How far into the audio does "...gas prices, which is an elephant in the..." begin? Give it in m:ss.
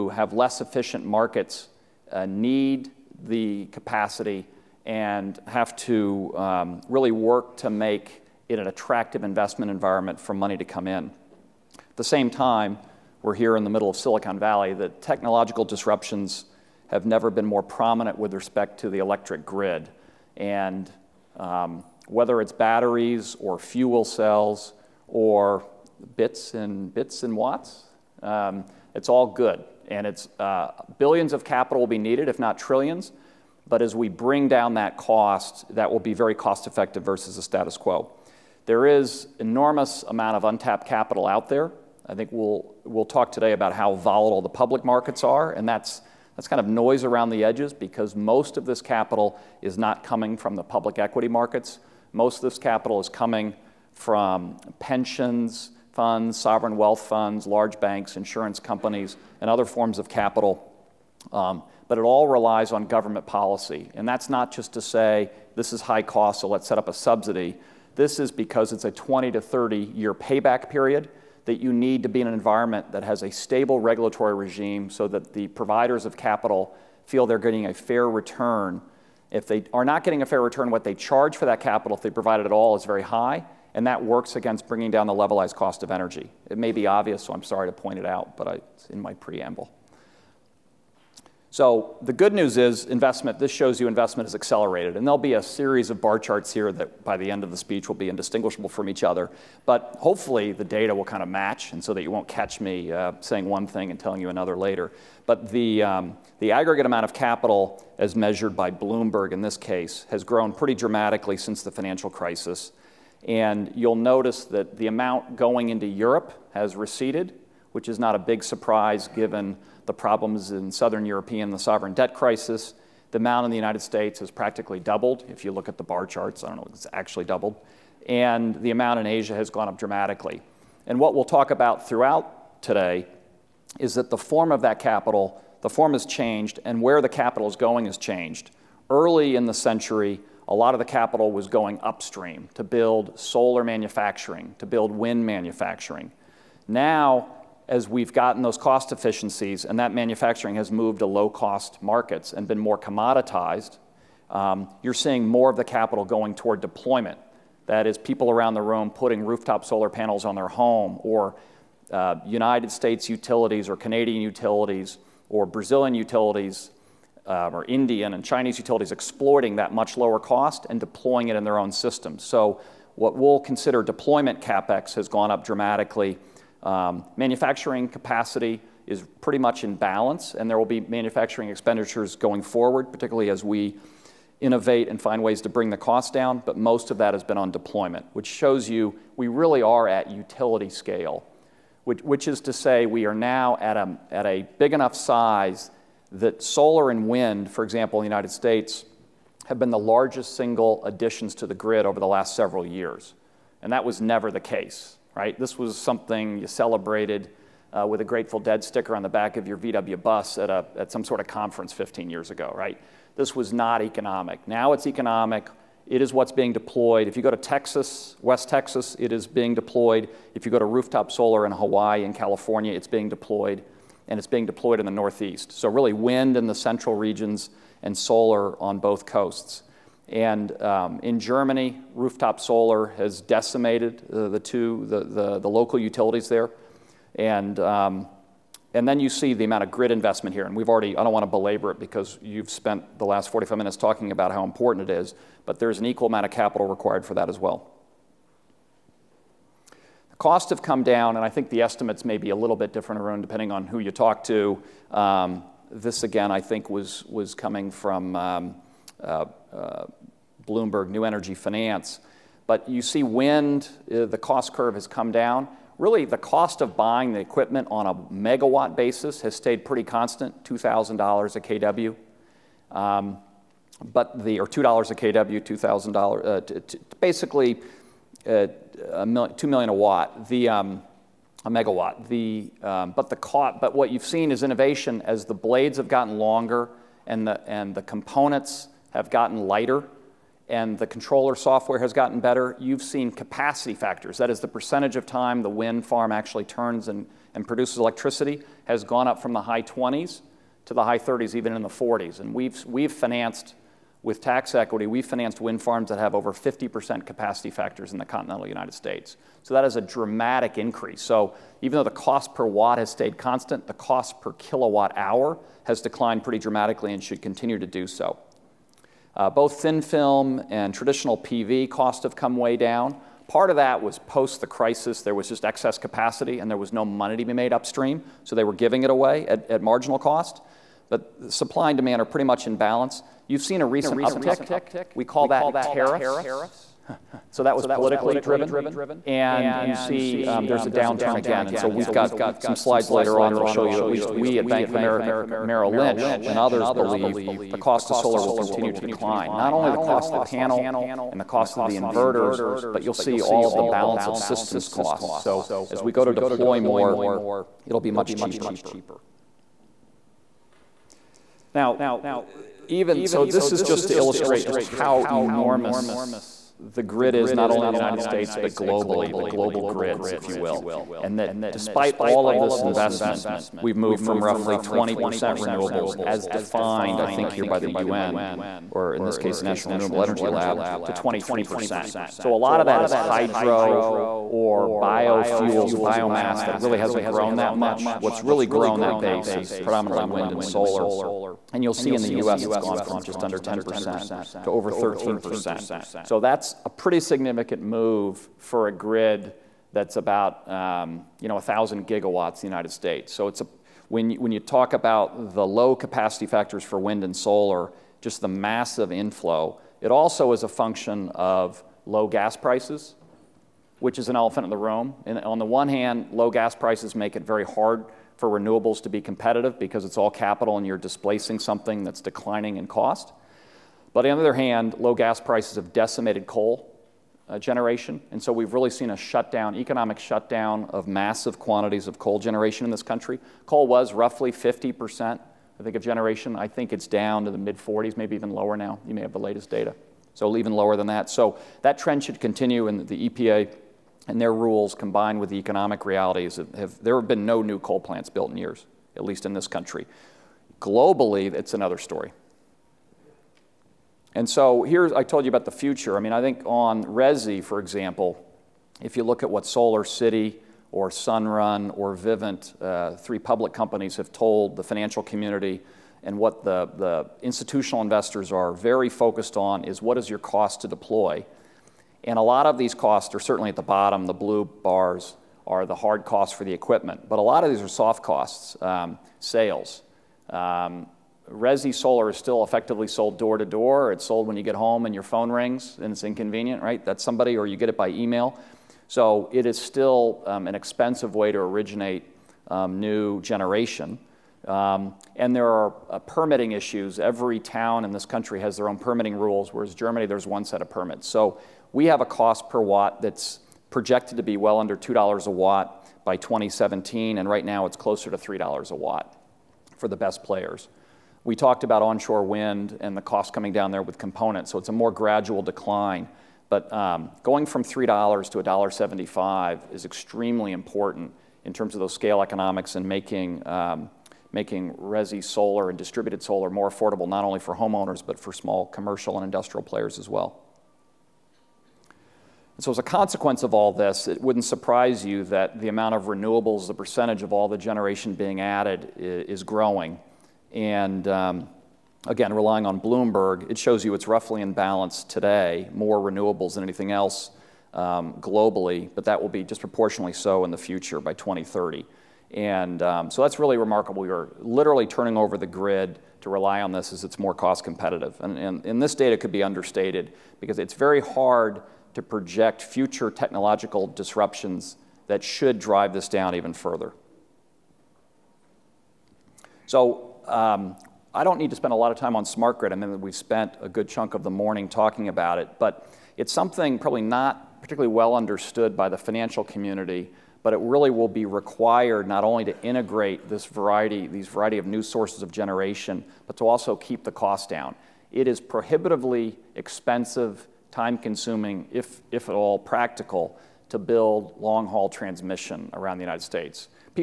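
6:52.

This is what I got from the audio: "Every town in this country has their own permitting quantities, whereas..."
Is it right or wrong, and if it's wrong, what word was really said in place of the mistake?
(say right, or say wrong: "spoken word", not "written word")
wrong: "rules", not "quantities".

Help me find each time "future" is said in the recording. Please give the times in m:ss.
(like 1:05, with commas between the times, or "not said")
7:35, 9:10, 9:22.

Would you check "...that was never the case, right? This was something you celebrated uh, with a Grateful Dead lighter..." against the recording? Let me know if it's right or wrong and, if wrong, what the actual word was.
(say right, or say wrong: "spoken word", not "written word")
wrong: "sticker", not "lighter".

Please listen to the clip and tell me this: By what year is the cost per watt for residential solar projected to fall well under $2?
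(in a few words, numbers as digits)
2017.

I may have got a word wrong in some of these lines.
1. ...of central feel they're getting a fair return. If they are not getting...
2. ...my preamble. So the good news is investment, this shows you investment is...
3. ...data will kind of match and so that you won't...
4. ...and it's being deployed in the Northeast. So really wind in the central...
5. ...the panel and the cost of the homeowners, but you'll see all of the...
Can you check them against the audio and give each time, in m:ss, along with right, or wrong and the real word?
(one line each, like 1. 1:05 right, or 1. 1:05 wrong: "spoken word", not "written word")
1. 1:16 wrong: "capital", not "central"
2. 1:28 right
3. 1:40 right
4. 3:44 right
5. 5:50 wrong: "inverters", not "homeowners".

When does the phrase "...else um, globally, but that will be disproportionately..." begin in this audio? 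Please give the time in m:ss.
9:06.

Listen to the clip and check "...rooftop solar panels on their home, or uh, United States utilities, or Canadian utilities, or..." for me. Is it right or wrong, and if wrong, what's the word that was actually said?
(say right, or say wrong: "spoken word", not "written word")
right.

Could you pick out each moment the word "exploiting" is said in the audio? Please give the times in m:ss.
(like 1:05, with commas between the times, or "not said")
2:48.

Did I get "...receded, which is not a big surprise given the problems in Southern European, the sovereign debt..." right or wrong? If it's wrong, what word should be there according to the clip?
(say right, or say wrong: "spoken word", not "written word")
right.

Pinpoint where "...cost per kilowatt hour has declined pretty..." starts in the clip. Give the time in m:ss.
5:13.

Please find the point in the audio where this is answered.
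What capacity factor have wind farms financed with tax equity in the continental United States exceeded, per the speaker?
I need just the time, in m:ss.
5:06.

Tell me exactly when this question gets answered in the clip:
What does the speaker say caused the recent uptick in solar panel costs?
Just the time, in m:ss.
5:35.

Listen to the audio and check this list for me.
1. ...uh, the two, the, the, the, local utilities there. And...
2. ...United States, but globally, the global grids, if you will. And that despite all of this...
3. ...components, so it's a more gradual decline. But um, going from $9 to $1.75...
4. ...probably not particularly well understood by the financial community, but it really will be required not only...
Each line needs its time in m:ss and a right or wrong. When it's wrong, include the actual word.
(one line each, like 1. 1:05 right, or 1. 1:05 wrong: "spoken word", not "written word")
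1. 3:54 right
2. 6:07 right
3. 8:33 wrong: "3", not "9"
4. 9:36 right.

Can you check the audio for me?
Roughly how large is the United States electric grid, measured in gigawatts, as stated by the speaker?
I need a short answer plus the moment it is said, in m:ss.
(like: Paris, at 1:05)
1,000 gigawatts, at 6:41.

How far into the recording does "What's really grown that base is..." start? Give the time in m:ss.
6:27.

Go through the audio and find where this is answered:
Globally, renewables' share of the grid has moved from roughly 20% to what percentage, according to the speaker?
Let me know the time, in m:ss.
6:20.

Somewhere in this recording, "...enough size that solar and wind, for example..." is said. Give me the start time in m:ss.
3:14.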